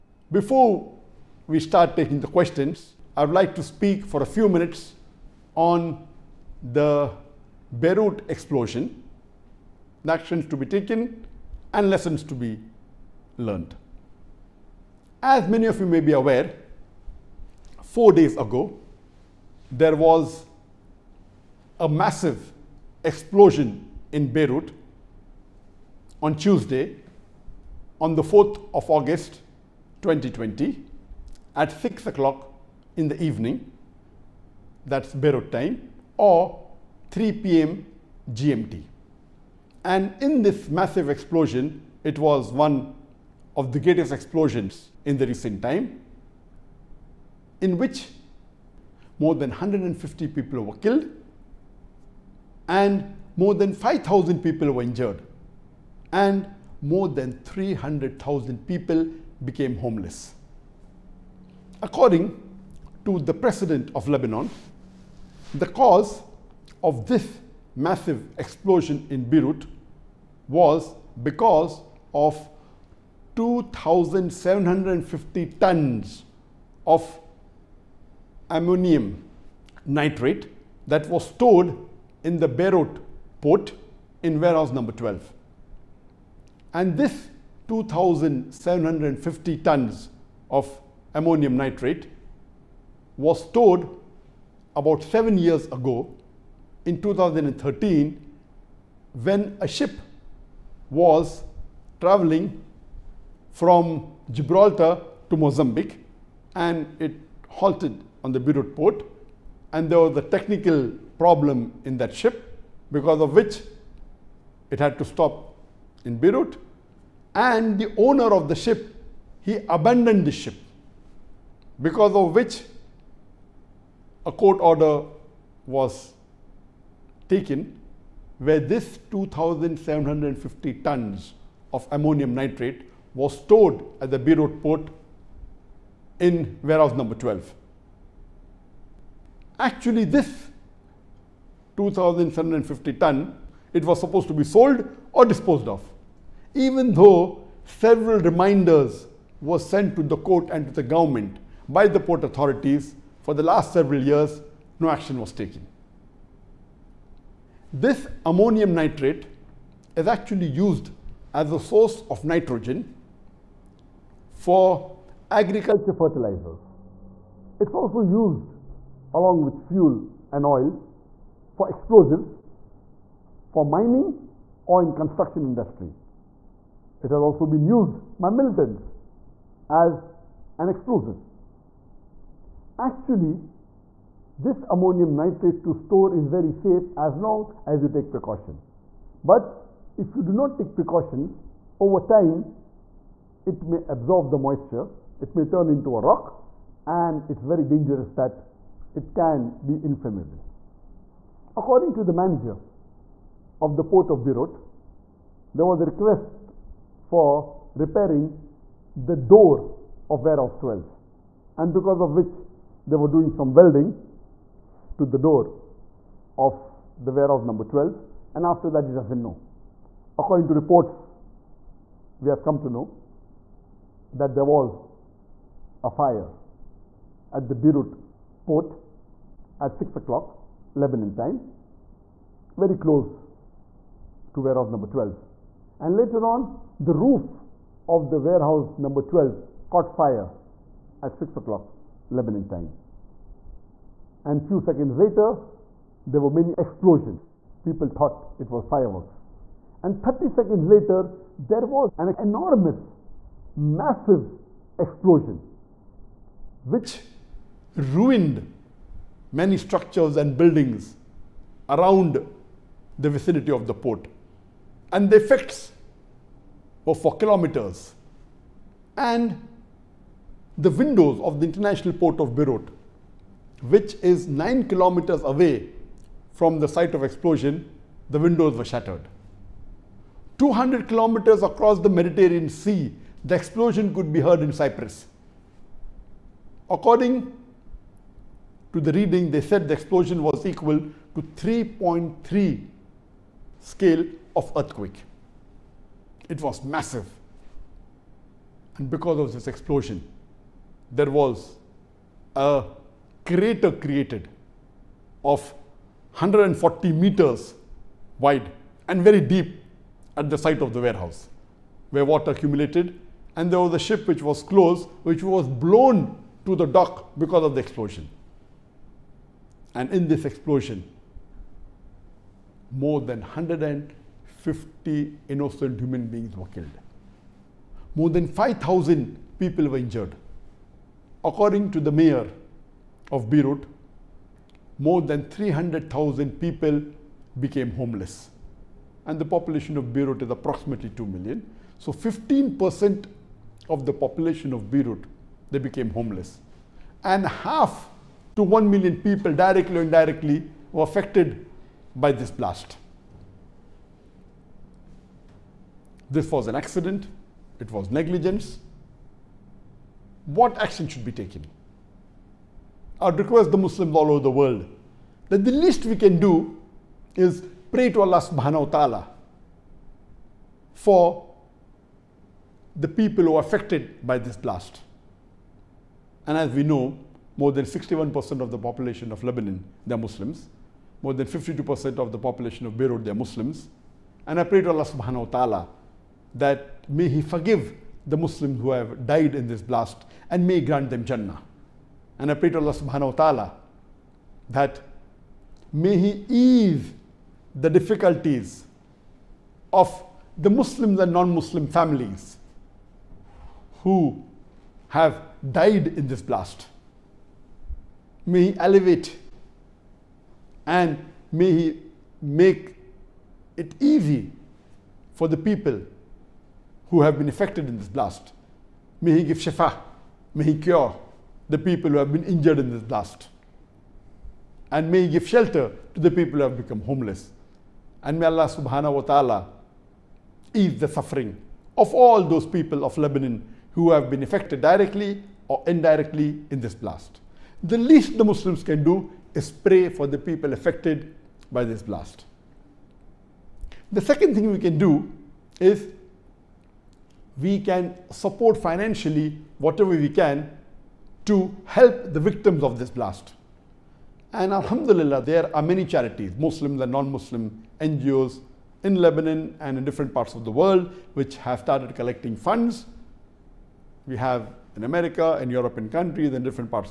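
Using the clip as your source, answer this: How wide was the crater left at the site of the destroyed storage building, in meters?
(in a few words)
140 meters.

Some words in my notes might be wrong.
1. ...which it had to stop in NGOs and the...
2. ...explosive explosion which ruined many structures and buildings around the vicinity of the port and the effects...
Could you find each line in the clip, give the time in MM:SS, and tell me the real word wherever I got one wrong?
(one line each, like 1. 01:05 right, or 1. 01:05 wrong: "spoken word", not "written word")
1. 01:53 wrong: "Beirut", not "NGOs"
2. 04:13 wrong: "massive", not "explosive".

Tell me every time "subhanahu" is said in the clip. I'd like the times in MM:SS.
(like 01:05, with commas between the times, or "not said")
06:08, 06:24, 06:32, 07:08.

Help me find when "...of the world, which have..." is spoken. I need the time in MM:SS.
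07:40.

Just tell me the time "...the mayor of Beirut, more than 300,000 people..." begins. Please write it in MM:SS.
05:31.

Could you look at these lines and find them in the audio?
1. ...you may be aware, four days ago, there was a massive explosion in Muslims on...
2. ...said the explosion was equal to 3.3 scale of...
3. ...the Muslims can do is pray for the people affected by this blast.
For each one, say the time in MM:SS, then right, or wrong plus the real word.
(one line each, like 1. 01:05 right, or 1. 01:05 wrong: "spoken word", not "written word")
1. 00:15 wrong: "Beirut", not "Muslims"
2. 04:49 right
3. 07:18 right.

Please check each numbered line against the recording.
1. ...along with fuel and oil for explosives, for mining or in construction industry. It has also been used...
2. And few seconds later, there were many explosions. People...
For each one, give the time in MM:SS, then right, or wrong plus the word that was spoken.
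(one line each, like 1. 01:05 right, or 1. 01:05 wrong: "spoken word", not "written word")
1. 02:49 right
2. 04:04 right.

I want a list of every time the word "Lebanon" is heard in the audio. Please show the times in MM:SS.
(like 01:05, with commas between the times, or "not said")
01:04, 03:50, 04:02, 06:19, 07:12, 07:38.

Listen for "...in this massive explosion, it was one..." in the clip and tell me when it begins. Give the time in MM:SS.
00:40.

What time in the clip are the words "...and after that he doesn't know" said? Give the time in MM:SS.
03:38.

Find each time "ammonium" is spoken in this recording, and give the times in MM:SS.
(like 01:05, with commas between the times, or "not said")
01:18, 01:31, 02:11, 02:38, 03:04.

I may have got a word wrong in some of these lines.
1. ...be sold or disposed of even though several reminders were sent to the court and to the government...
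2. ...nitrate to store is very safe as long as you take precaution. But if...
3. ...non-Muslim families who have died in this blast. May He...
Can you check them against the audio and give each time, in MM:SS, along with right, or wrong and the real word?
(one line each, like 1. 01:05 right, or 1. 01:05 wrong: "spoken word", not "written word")
1. 02:24 right
2. 03:05 right
3. 06:41 right.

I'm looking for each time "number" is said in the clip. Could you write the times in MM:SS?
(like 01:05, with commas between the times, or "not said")
01:24, 02:16, 03:37, 03:54, 03:58.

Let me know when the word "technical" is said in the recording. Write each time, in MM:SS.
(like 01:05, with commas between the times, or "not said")
01:50.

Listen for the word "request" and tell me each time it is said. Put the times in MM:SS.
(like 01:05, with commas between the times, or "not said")
03:25, 06:03.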